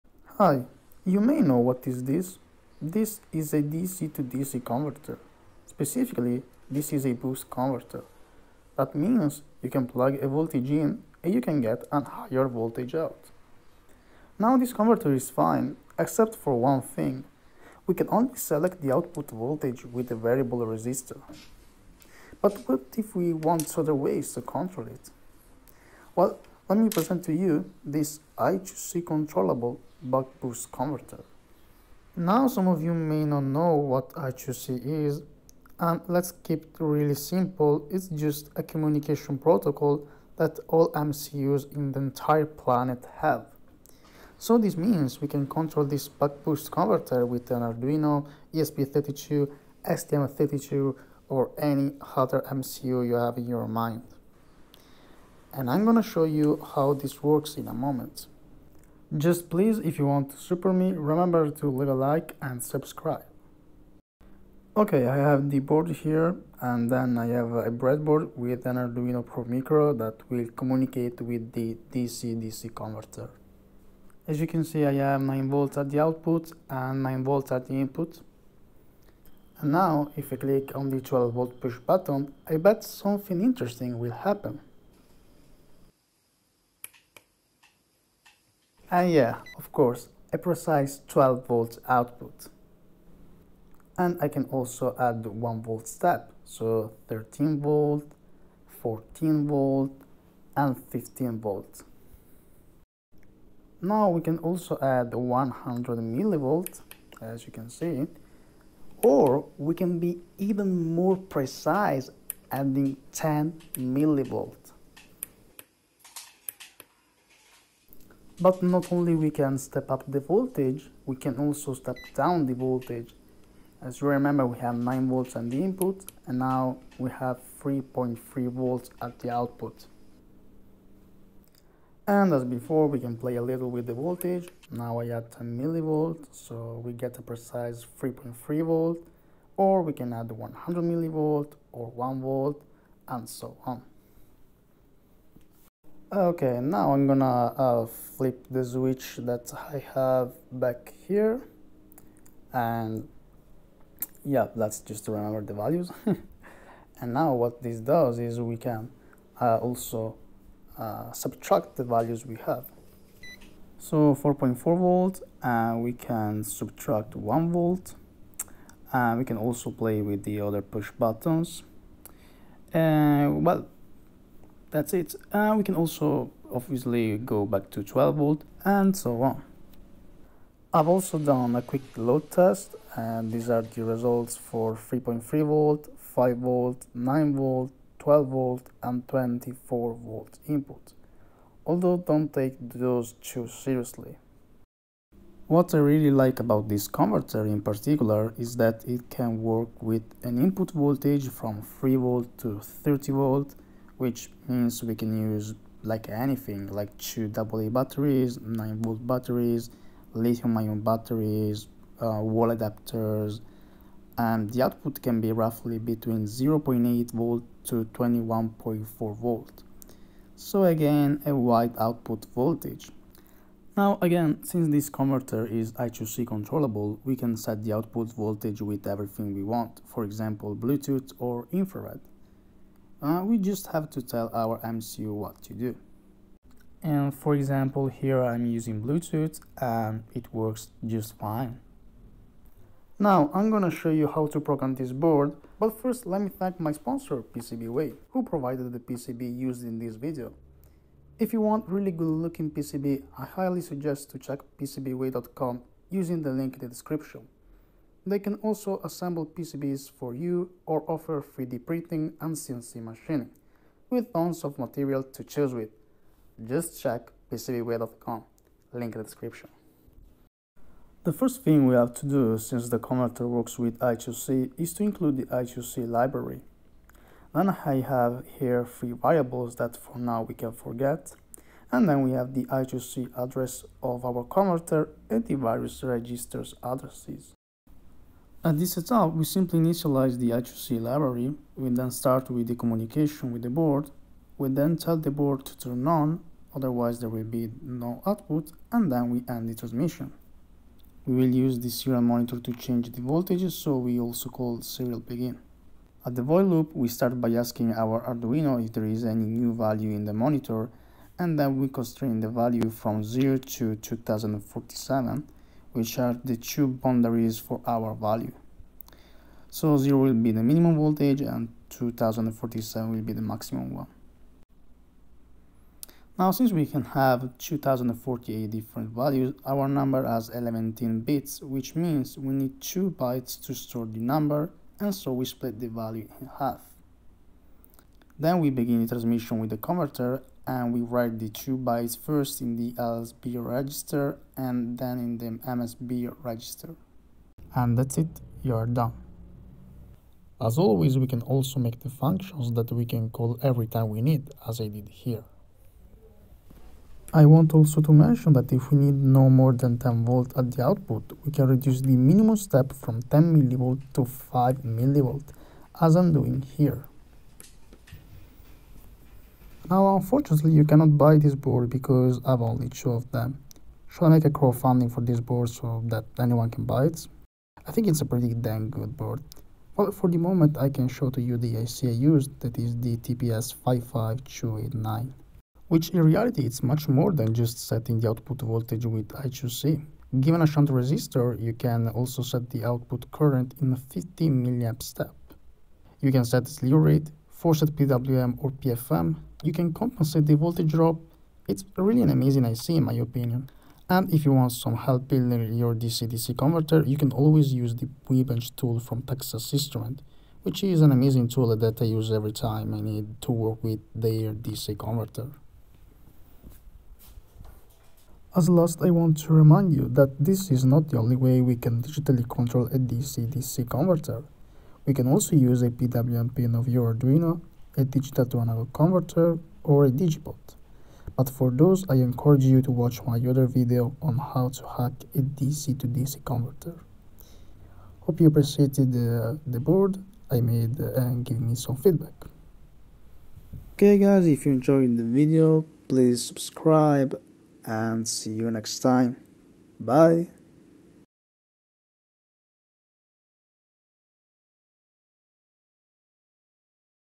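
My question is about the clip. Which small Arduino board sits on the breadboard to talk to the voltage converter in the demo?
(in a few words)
Arduino Pro Micro.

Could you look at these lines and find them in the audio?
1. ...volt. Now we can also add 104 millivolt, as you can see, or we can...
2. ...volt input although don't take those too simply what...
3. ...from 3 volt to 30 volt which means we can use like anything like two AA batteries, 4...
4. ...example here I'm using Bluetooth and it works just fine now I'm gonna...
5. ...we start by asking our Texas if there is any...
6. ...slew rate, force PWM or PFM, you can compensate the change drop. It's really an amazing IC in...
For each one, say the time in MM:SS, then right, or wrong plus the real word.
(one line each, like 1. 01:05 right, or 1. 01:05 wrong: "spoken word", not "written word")
1. 01:41 wrong: "100", not "104"
2. 03:10 wrong: "seriously", not "simply"
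3. 03:21 wrong: "9", not "4"
4. 03:57 right
5. 05:06 wrong: "Arduino", not "Texas"
6. 06:36 wrong: "voltage", not "change".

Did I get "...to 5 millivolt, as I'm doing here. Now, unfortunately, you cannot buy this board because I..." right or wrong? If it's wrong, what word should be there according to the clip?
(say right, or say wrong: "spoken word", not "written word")
right.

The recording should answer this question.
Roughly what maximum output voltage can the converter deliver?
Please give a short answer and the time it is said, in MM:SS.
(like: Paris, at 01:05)
21.4 volt, at 03:37.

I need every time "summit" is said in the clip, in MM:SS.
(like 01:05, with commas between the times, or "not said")
not said.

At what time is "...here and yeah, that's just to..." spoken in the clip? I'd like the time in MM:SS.
02:31.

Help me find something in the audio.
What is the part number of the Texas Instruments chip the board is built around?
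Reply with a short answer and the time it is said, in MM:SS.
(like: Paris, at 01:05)
TPS 55289, at 06:22.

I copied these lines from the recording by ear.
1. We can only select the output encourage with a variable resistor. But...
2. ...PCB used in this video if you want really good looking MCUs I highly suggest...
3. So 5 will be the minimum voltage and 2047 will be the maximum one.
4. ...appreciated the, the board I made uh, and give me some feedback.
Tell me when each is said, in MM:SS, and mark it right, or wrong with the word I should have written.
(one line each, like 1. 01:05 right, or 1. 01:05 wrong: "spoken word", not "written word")
1. 00:17 wrong: "voltage", not "encourage"
2. 04:08 wrong: "PCB", not "MCUs"
3. 05:19 wrong: "0", not "5"
4. 07:18 right.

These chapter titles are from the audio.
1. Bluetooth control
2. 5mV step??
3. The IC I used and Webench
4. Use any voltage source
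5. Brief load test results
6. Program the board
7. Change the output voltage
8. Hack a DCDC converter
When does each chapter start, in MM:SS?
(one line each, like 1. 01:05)
1. 03:43
2. 05:56
3. 06:10
4. 03:15
5. 03:00
6. 04:30
7. 01:04
8. 06:58.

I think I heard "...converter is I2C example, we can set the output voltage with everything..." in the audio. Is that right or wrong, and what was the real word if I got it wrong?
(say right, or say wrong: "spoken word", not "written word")
wrong: "controllable", not "example".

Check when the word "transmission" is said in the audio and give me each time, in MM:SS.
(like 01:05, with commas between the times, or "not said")
04:59, 05:38.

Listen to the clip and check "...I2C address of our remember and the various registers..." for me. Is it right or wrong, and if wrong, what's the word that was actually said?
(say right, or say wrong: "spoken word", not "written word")
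wrong: "converter", not "remember".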